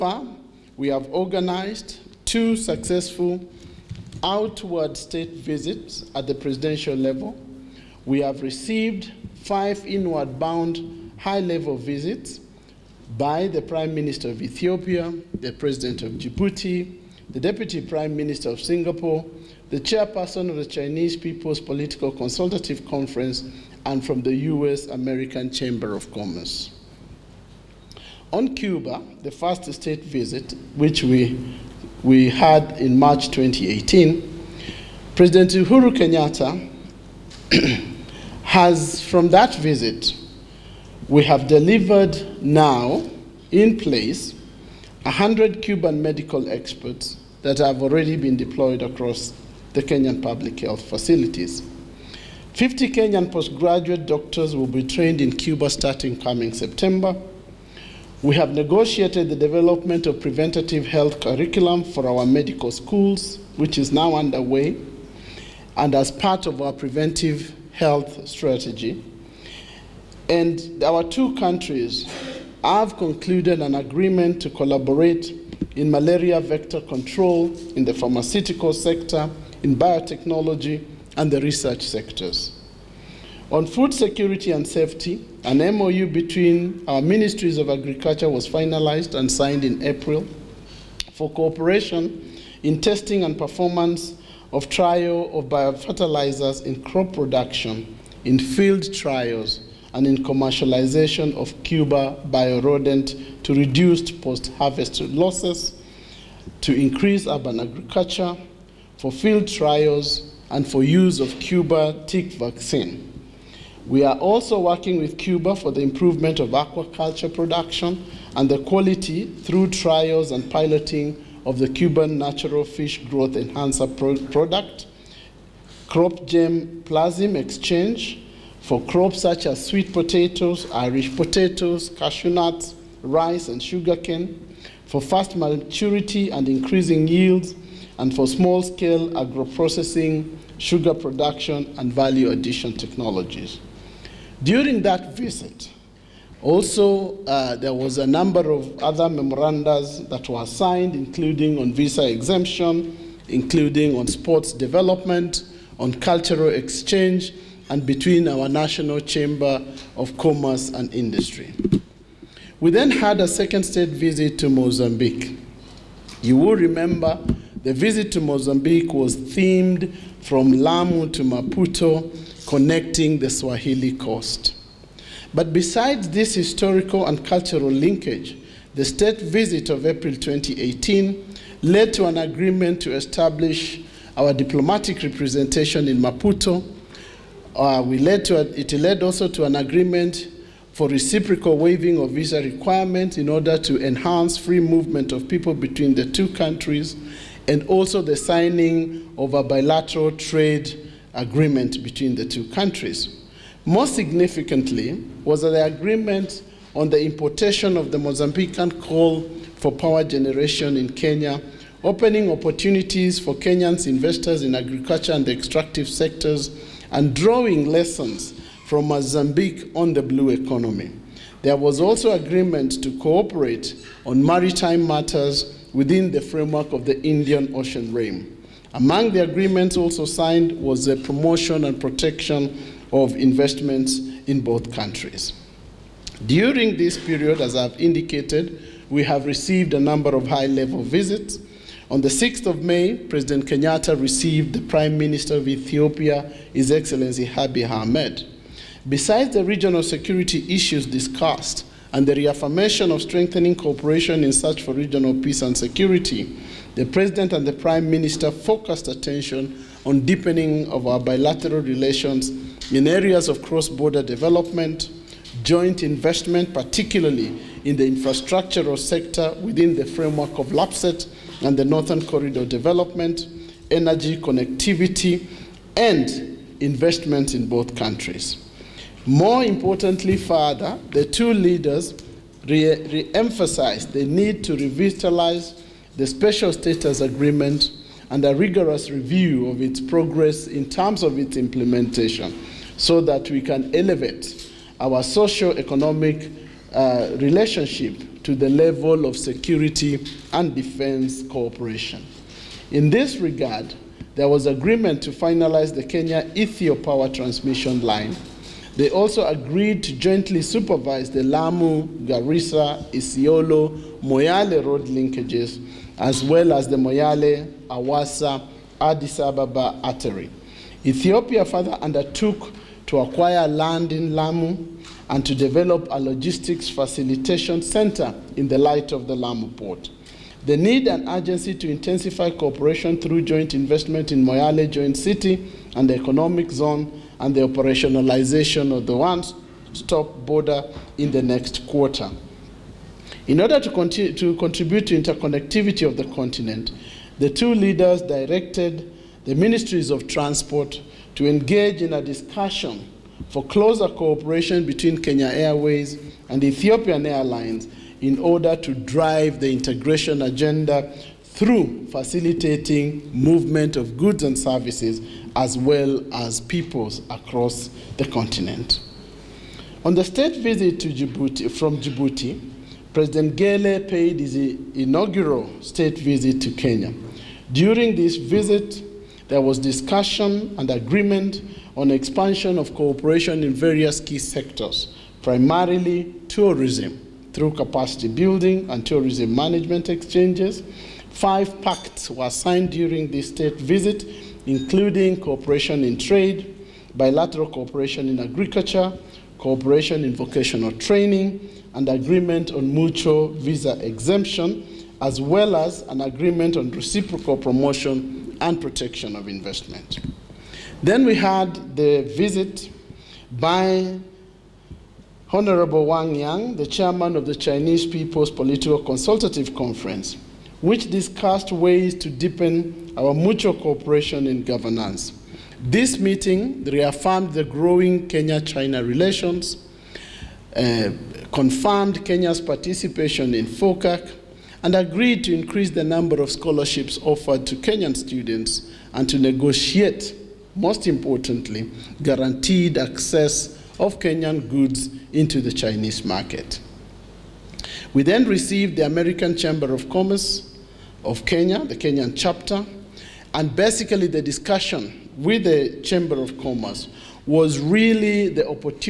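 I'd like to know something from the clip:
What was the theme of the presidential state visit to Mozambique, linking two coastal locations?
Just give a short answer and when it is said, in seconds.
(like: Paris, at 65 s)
From Lamu to Maputo, at 170 s.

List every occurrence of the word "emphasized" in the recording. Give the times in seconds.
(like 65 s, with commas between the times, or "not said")
283 s.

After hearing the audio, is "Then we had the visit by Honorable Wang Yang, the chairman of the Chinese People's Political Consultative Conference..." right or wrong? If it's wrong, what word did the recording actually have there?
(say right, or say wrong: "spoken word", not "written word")
right.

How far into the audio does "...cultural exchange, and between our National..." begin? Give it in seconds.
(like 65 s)
155 s.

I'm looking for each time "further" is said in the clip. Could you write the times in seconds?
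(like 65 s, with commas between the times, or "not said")
280 s, 321 s.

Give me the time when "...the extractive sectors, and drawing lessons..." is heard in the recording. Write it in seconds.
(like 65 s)
215 s.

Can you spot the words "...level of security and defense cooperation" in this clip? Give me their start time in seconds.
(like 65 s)
298 s.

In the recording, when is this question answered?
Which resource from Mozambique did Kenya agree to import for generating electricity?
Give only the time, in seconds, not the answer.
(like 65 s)
208 s.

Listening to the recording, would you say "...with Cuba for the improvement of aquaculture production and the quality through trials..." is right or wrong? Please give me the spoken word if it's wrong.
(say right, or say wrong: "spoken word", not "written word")
right.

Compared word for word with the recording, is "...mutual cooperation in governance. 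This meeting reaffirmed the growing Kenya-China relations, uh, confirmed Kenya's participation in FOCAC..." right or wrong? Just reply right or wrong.
right.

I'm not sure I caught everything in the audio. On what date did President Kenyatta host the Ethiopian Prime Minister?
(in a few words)
6th of May.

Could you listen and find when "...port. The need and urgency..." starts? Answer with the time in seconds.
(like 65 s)
329 s.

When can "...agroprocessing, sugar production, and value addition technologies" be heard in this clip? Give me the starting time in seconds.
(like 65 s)
139 s.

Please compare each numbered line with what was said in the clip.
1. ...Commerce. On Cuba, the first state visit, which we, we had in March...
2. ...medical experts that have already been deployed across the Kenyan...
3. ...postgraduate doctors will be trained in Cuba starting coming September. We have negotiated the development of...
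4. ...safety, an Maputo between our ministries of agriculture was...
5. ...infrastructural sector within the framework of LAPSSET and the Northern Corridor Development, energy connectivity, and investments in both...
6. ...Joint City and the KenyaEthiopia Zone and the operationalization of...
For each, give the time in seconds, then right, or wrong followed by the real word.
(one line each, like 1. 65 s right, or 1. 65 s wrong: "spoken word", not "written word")
1. 26 s right
2. 46 s right
3. 53 s right
4. 84 s wrong: "MOU", not "Maputo"
5. 267 s right
6. 334 s wrong: "Economic", not "KenyaEthiopia".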